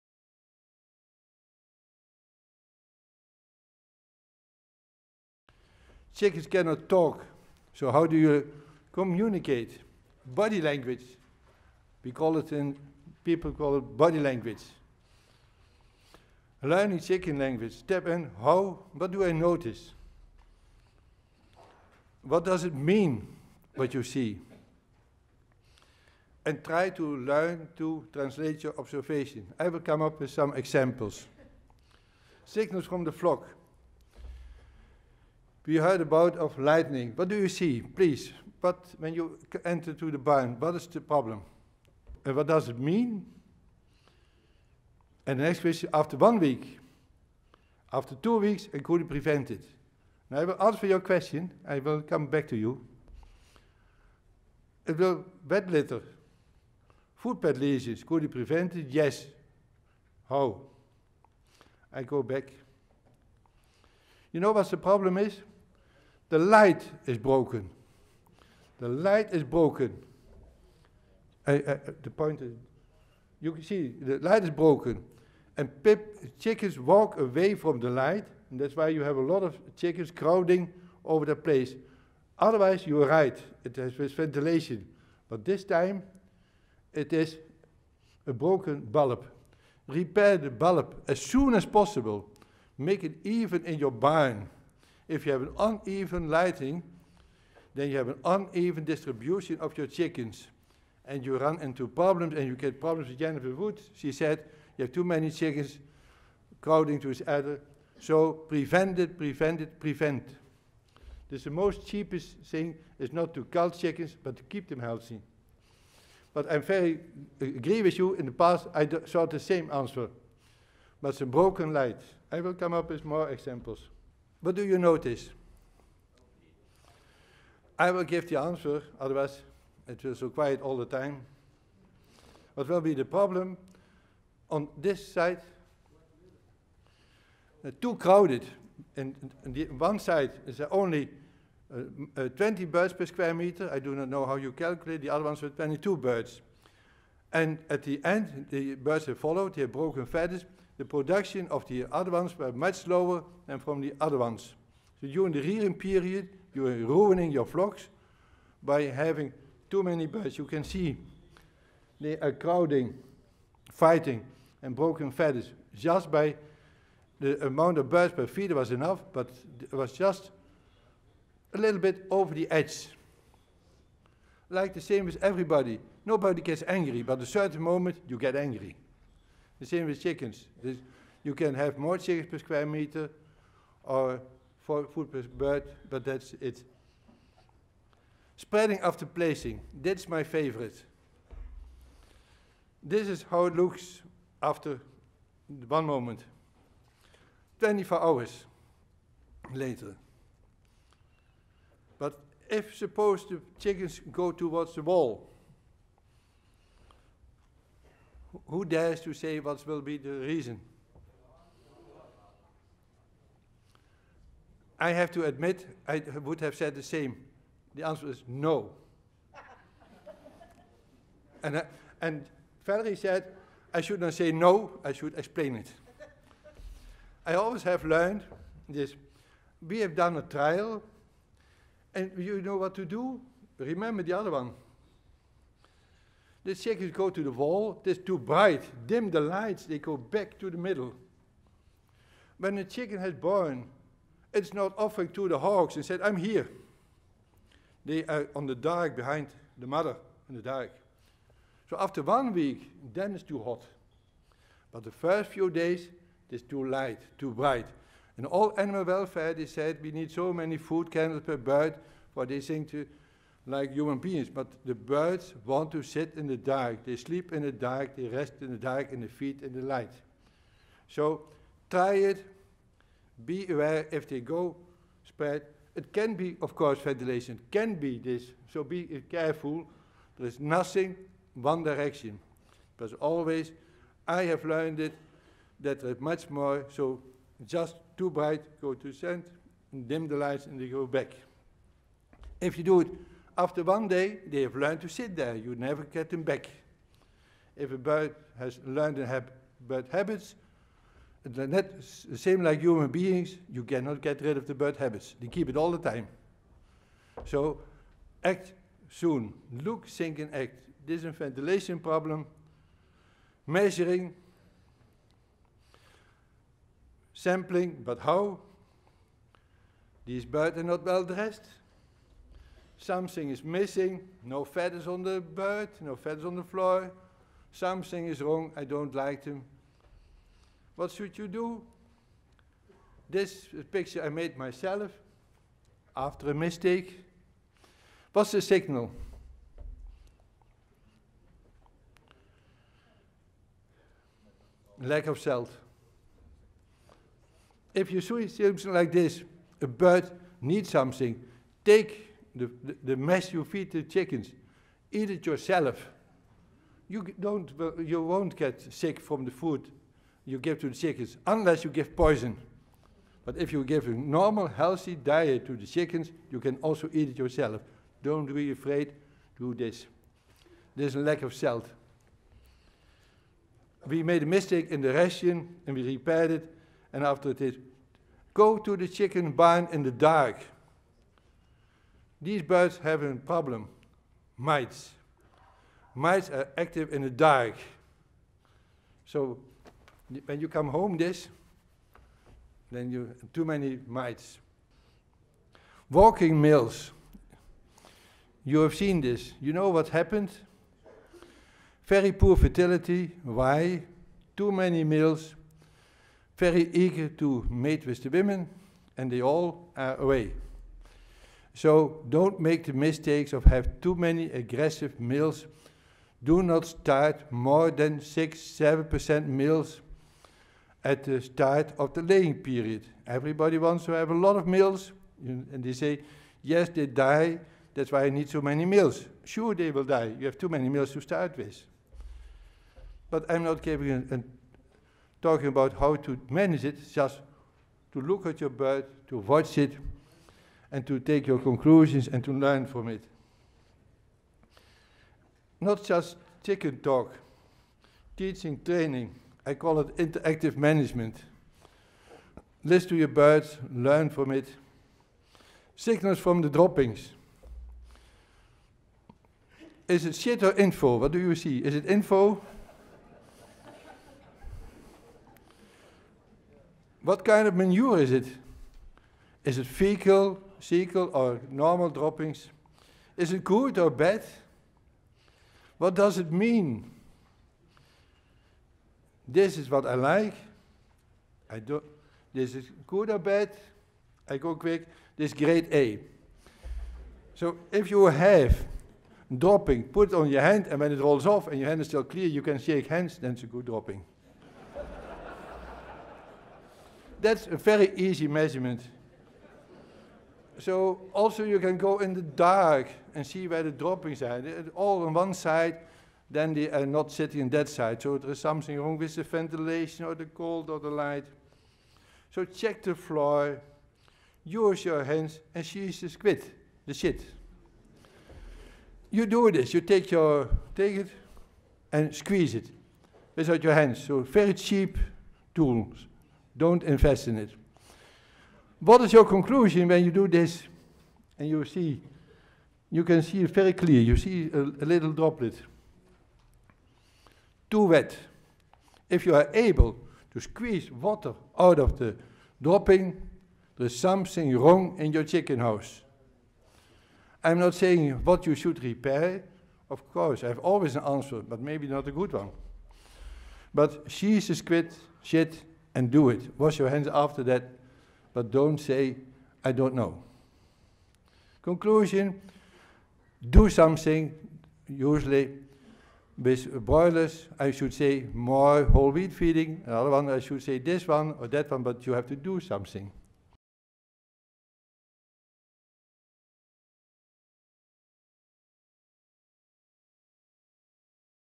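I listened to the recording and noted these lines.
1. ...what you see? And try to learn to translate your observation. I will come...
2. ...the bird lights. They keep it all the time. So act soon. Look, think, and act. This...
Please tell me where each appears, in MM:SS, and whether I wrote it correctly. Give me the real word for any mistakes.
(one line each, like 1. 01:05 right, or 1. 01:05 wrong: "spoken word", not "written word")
1. 00:23 right
2. 05:04 wrong: "habits", not "lights".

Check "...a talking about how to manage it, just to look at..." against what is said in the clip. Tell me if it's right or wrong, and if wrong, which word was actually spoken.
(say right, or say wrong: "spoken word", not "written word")
right.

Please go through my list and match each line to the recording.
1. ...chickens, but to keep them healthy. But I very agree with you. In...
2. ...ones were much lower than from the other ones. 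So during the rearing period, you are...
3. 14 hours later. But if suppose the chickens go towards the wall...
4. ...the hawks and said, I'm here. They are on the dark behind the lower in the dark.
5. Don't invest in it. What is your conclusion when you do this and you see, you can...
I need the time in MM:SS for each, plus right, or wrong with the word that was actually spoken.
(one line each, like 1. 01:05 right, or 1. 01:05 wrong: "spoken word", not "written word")
1. 01:53 right
2. 02:32 right
3. 03:17 wrong: "24", not "14"
4. 04:05 wrong: "mother", not "lower"
5. 08:46 right.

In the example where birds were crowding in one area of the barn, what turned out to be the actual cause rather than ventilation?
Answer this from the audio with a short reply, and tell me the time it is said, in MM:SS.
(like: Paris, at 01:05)
Broken bulb, at 01:28.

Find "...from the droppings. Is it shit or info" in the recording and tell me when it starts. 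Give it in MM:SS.
07:36.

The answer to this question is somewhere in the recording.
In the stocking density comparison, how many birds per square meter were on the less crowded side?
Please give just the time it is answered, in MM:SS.
02:22.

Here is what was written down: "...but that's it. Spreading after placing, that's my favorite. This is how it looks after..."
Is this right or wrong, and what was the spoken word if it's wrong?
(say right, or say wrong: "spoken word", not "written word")
right.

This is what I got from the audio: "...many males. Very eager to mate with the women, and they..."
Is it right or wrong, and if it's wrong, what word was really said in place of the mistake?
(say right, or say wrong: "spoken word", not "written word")
right.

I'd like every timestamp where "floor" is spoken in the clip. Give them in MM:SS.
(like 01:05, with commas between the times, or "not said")
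05:26, 08:32.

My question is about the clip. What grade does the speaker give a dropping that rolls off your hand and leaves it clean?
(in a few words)
Grade A.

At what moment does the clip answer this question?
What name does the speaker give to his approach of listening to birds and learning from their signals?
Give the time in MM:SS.
07:29.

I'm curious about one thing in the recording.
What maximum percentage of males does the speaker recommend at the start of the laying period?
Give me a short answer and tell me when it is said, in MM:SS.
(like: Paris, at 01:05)
6-7%, at 06:57.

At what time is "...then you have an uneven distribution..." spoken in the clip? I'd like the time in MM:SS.
01:37.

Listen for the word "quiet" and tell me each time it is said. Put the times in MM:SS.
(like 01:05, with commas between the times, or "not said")
02:10.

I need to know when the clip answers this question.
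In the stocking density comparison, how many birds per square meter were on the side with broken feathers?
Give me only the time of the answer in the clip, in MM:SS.
02:25.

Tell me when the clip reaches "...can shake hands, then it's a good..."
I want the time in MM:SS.
08:12.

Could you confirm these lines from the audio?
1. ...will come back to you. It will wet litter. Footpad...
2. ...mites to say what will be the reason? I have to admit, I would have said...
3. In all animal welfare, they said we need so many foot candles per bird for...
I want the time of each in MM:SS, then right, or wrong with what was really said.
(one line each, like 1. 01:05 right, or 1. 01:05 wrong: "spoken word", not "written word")
1. 00:51 right
2. 03:28 wrong: "dares", not "mites"
3. 04:18 right.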